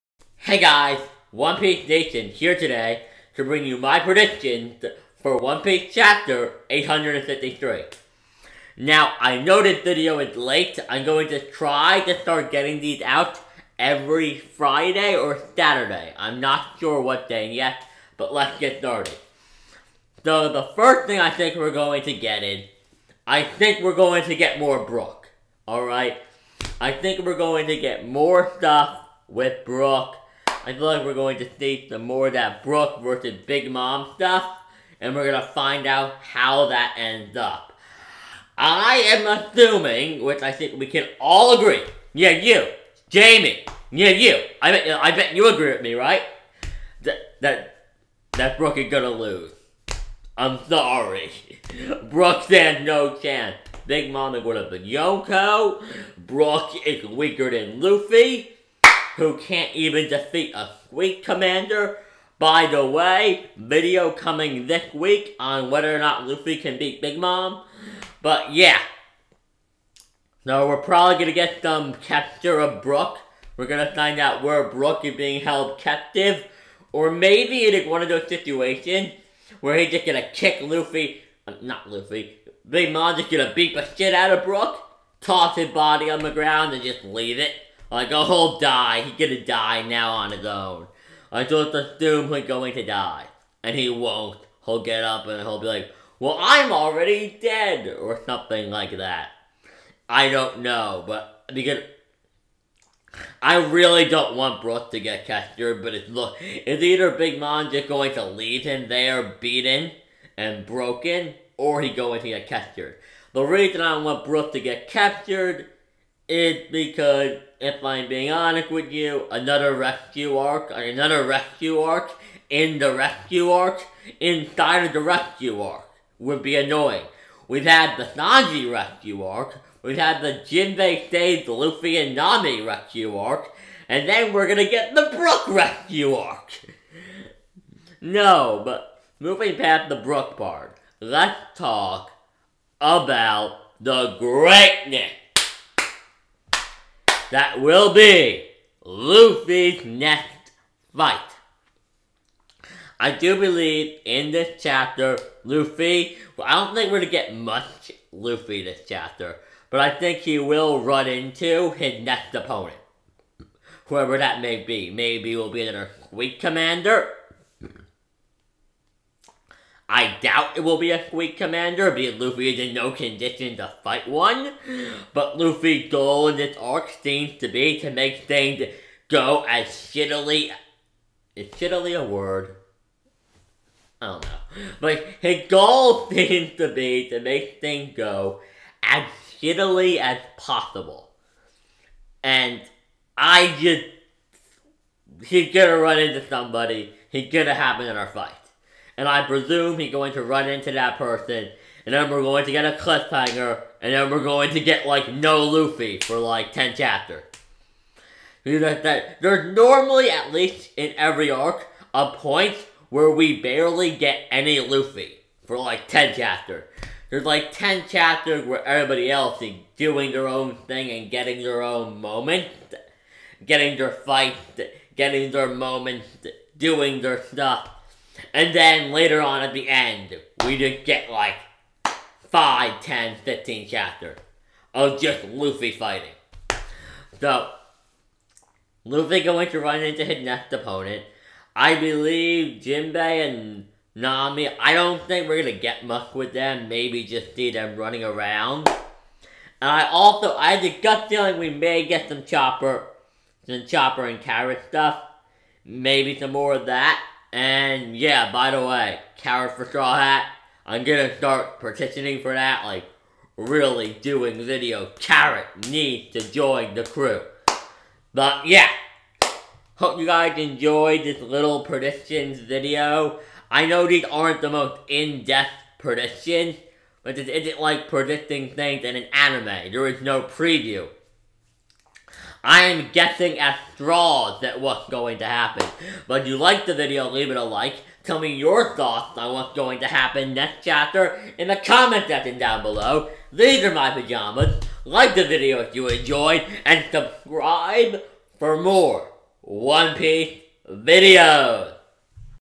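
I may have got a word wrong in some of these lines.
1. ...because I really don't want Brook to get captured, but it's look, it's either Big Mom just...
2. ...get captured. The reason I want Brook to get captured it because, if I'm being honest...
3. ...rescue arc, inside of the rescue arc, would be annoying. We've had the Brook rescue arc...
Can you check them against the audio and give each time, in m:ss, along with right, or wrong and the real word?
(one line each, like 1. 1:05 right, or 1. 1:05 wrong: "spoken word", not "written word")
1. 1:41 right
2. 1:52 right
3. 2:02 wrong: "Sanji", not "Brook".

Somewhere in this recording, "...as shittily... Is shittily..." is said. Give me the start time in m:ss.
2:59.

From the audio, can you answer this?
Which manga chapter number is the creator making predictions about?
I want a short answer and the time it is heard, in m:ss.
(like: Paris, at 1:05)
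853, at 0:06.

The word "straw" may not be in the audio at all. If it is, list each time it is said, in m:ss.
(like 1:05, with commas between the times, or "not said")
4:19, 4:43.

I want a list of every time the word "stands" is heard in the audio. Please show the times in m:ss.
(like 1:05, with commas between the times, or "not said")
0:52.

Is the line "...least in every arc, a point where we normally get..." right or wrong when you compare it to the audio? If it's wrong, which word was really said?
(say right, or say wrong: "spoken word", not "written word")
wrong: "barely", not "normally".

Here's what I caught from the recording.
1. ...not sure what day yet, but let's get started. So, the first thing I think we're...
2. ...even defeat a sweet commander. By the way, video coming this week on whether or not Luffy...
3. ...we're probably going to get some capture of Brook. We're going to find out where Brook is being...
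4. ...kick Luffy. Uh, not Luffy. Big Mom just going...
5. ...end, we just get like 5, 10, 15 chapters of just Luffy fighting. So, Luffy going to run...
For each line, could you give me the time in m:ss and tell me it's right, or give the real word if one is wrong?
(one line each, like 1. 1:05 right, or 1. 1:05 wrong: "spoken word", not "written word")
1. 0:16 right
2. 0:59 right
3. 1:10 right
4. 1:20 right
5. 3:49 right.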